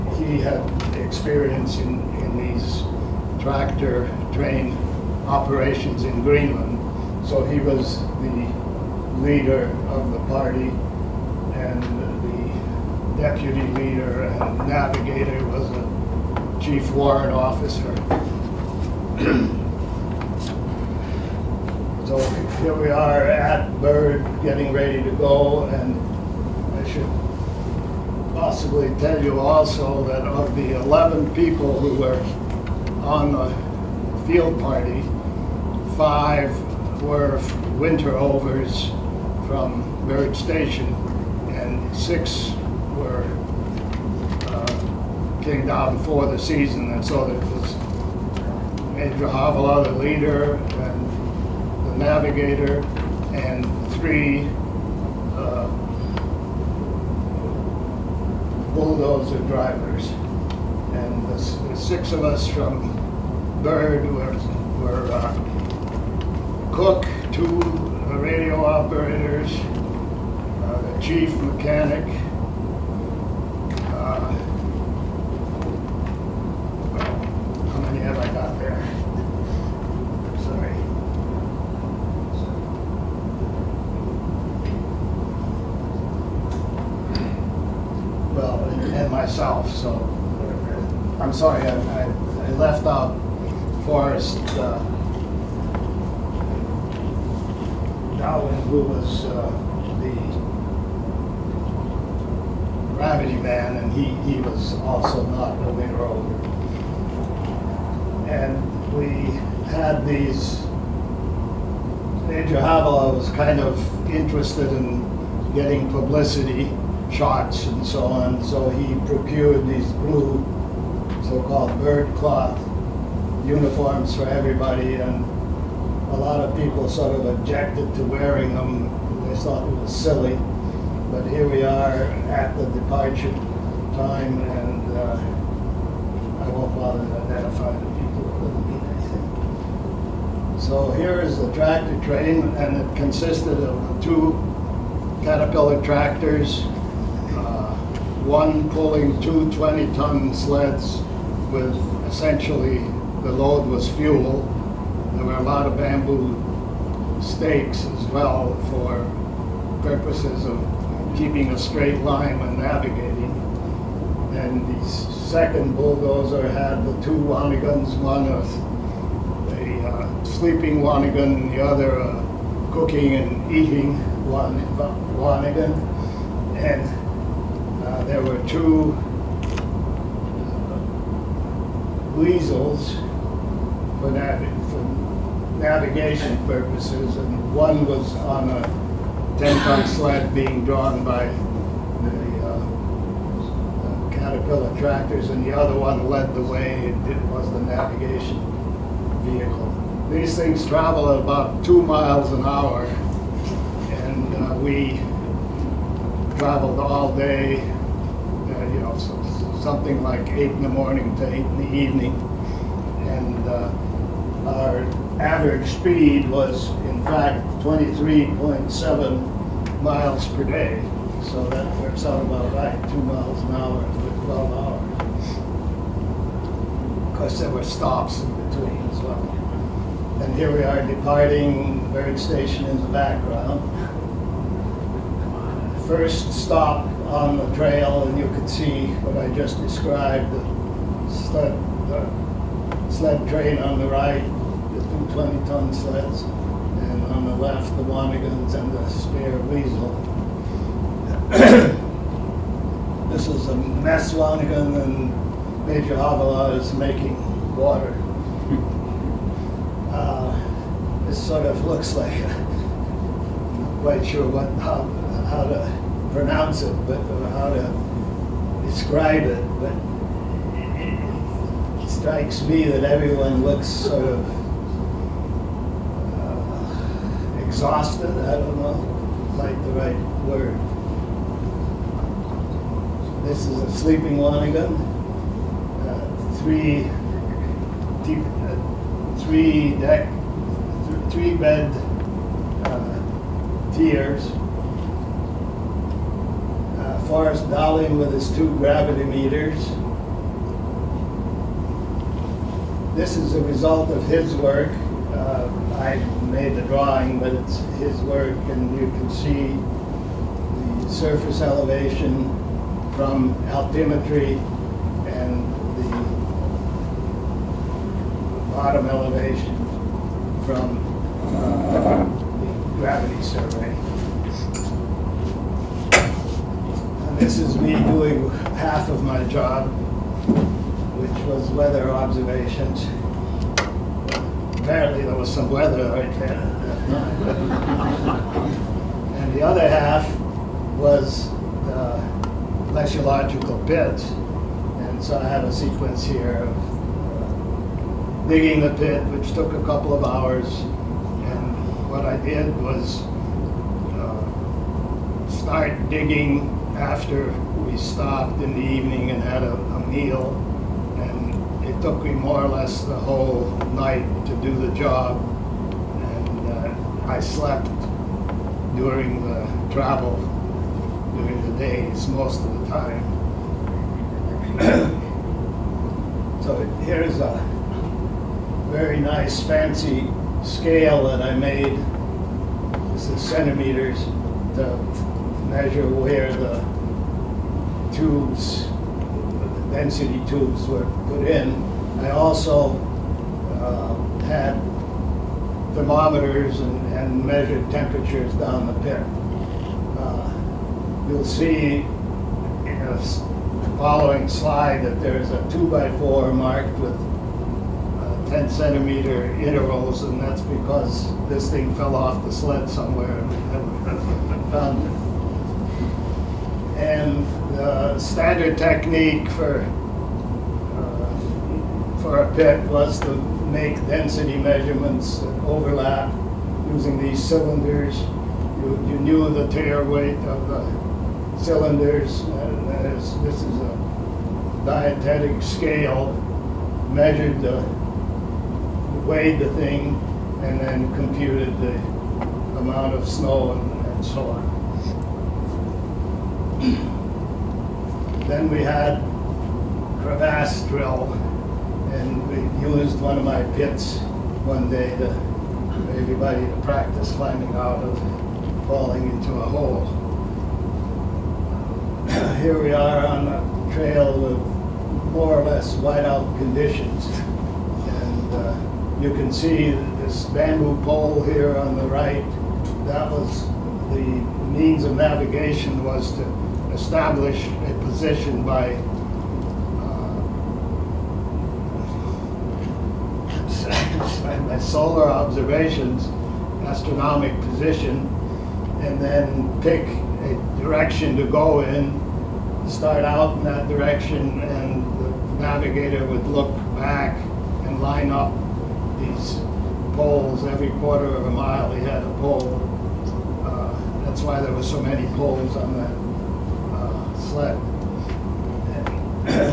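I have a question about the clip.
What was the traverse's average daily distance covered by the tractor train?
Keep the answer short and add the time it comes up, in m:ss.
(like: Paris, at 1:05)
23.7 miles, at 3:37.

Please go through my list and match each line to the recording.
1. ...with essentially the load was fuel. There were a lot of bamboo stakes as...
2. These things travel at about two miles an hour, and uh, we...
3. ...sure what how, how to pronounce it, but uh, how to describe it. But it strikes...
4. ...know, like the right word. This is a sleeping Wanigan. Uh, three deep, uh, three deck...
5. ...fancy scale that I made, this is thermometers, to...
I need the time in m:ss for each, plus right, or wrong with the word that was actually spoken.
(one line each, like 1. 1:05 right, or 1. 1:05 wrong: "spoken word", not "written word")
1. 2:31 right
2. 3:20 right
3. 4:24 right
4. 4:38 right
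5. 6:19 wrong: "centimeters", not "thermometers".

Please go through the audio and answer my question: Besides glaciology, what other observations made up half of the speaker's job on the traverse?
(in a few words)
weather observations.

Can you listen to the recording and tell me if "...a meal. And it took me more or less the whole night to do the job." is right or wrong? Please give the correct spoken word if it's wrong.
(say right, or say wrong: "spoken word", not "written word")
right.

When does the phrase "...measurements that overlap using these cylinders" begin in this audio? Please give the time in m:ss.
7:04.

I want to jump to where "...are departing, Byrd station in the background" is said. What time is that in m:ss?
3:50.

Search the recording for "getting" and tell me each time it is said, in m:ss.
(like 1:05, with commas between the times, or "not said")
0:24, 1:55.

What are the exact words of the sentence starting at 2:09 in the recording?
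They thought it was silly, but here we are at the departure time, and uh, I won't bother to identify them.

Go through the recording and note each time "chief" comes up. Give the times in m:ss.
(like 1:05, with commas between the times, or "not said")
0:16, 1:11.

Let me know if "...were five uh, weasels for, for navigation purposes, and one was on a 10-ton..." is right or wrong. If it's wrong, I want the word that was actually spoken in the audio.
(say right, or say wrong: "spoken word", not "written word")
wrong: "two", not "five".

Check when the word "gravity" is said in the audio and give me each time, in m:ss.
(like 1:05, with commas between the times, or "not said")
4:58, 5:22.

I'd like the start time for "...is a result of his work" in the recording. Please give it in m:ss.
5:03.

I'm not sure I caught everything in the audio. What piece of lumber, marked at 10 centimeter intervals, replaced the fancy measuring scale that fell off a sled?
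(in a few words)
2 by 4.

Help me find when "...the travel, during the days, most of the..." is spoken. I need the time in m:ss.
6:09.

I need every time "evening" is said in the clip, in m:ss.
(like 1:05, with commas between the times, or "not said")
3:31, 5:58.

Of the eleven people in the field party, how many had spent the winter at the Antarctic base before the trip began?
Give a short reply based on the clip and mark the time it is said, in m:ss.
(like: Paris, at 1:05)
5, at 0:35.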